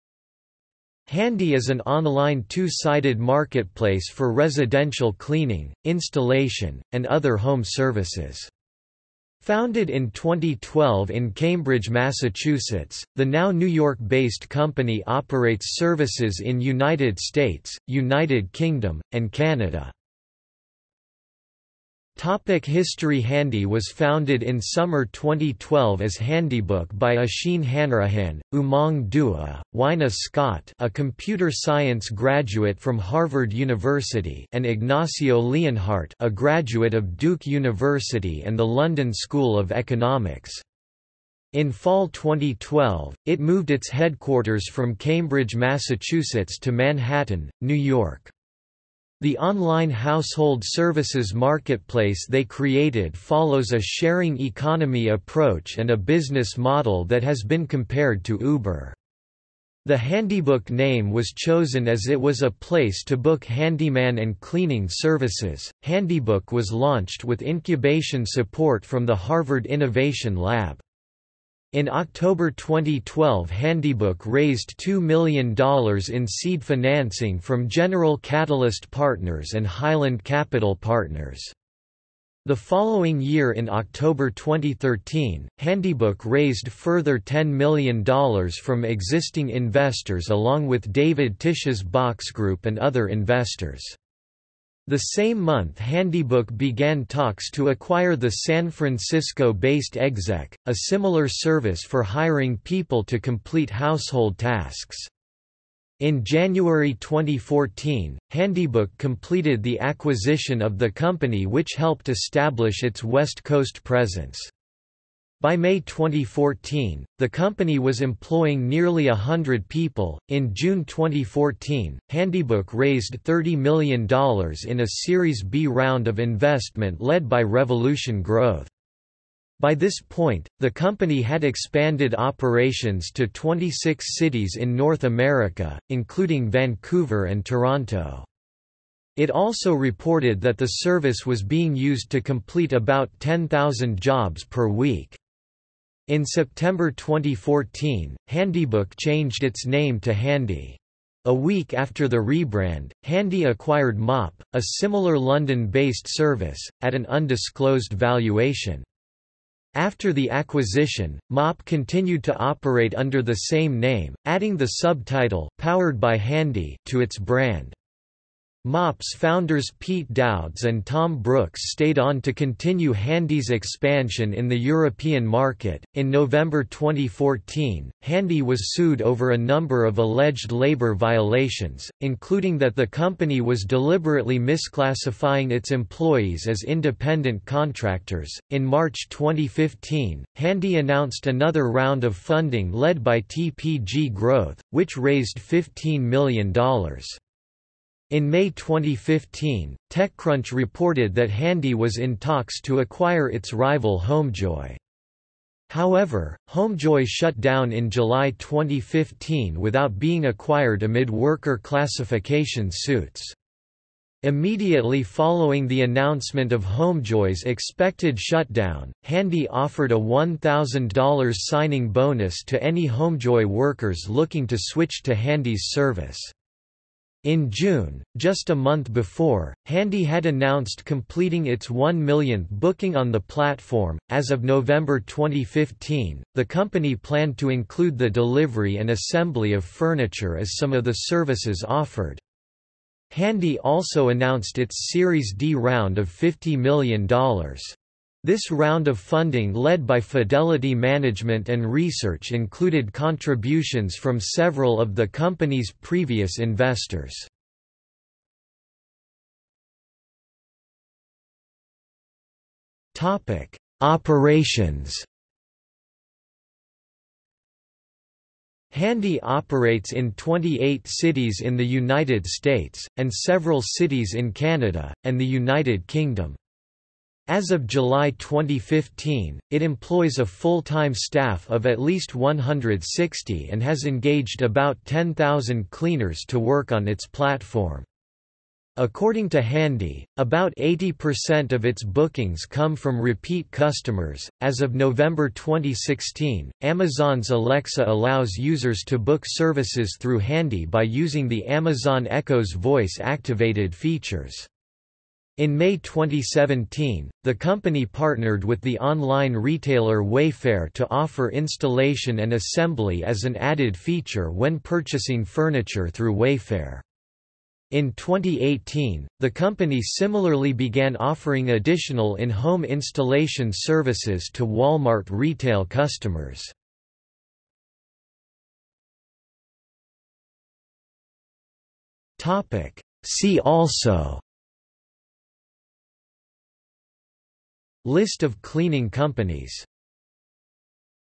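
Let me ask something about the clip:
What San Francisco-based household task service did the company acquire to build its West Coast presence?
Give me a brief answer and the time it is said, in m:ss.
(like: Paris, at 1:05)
Exec, at 1:39.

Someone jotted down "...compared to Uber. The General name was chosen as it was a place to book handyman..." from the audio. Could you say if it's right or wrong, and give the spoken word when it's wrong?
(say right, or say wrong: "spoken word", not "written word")
wrong: "Handybook", not "General".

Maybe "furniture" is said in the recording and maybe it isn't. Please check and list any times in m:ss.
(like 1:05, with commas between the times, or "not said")
3:59, 5:15.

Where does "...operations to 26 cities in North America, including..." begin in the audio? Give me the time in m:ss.
2:12.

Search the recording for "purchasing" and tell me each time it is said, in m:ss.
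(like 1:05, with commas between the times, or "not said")
5:14.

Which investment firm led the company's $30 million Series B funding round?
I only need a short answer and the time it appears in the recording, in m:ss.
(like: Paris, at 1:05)
Revolution Growth, at 2:07.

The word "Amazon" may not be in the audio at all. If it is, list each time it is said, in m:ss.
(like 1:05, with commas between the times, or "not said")
4:56, 5:01.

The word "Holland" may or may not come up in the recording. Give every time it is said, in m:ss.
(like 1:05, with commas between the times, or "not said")
not said.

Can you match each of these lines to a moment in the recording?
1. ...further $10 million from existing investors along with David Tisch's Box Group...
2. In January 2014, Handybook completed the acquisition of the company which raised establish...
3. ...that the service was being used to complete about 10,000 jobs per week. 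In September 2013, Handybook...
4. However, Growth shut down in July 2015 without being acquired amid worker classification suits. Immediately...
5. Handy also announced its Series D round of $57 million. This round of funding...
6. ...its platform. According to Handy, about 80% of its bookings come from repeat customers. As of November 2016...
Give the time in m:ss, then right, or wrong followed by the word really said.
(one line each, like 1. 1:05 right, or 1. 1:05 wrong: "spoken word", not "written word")
1. 1:26 right
2. 1:45 wrong: "helped", not "raised"
3. 2:20 wrong: "2014", not "2013"
4. 3:25 wrong: "Homejoy", not "Growth"
5. 4:03 wrong: "50", not "57"
6. 4:46 right.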